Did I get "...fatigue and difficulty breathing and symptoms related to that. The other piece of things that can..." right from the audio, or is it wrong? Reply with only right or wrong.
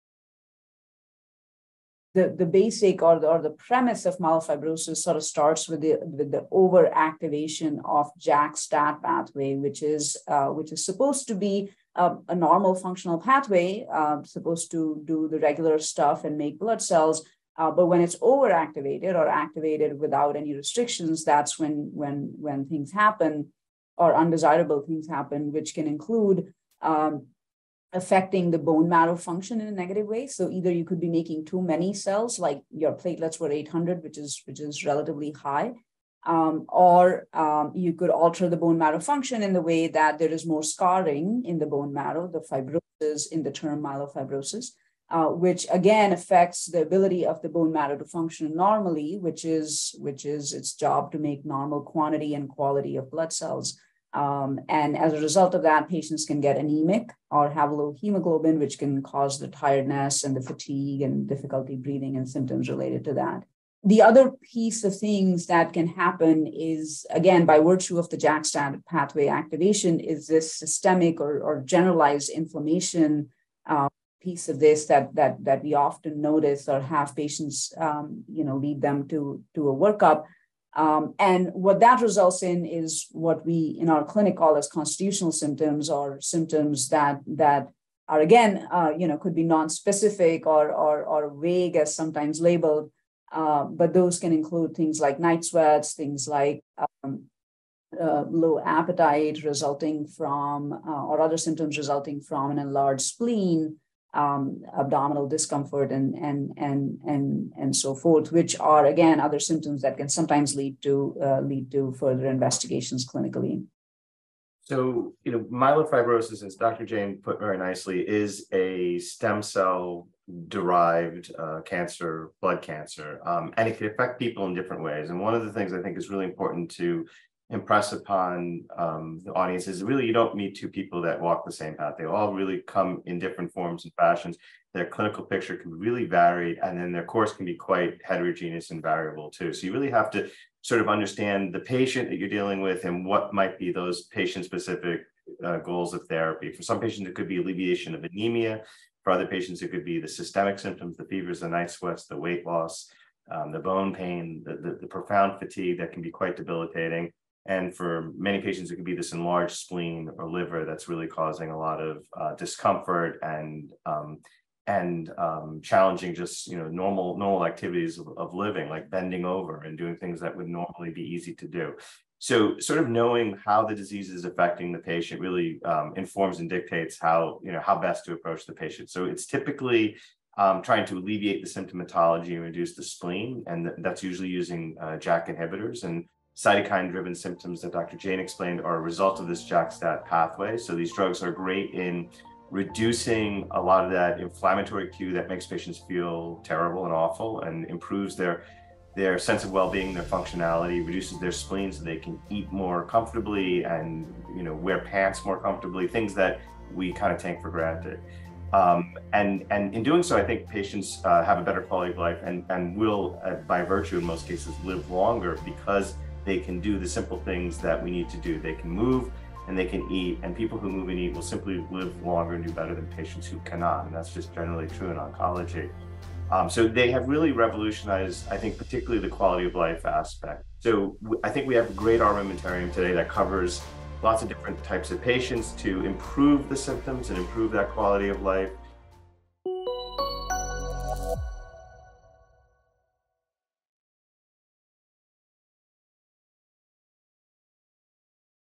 right.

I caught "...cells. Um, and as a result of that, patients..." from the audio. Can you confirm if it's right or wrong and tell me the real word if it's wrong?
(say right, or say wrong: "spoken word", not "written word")
right.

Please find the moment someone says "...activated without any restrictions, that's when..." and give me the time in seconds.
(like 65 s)
19 s.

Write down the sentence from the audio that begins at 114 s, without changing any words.
So, you know, myelofibrosis, as Dr.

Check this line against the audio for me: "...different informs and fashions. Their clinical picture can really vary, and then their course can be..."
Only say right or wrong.
wrong.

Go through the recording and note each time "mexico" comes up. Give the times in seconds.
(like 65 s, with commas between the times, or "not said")
not said.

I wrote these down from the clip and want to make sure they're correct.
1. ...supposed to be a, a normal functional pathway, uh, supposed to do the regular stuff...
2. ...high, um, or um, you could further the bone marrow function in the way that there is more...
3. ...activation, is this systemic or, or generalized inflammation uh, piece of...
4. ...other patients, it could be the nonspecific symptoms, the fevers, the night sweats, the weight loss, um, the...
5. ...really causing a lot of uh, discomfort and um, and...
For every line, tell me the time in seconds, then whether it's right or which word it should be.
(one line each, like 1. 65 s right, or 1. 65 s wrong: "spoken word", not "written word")
1. 10 s right
2. 35 s wrong: "alter", not "further"
3. 69 s right
4. 149 s wrong: "systemic", not "nonspecific"
5. 160 s right.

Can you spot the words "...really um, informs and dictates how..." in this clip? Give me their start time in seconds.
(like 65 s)
175 s.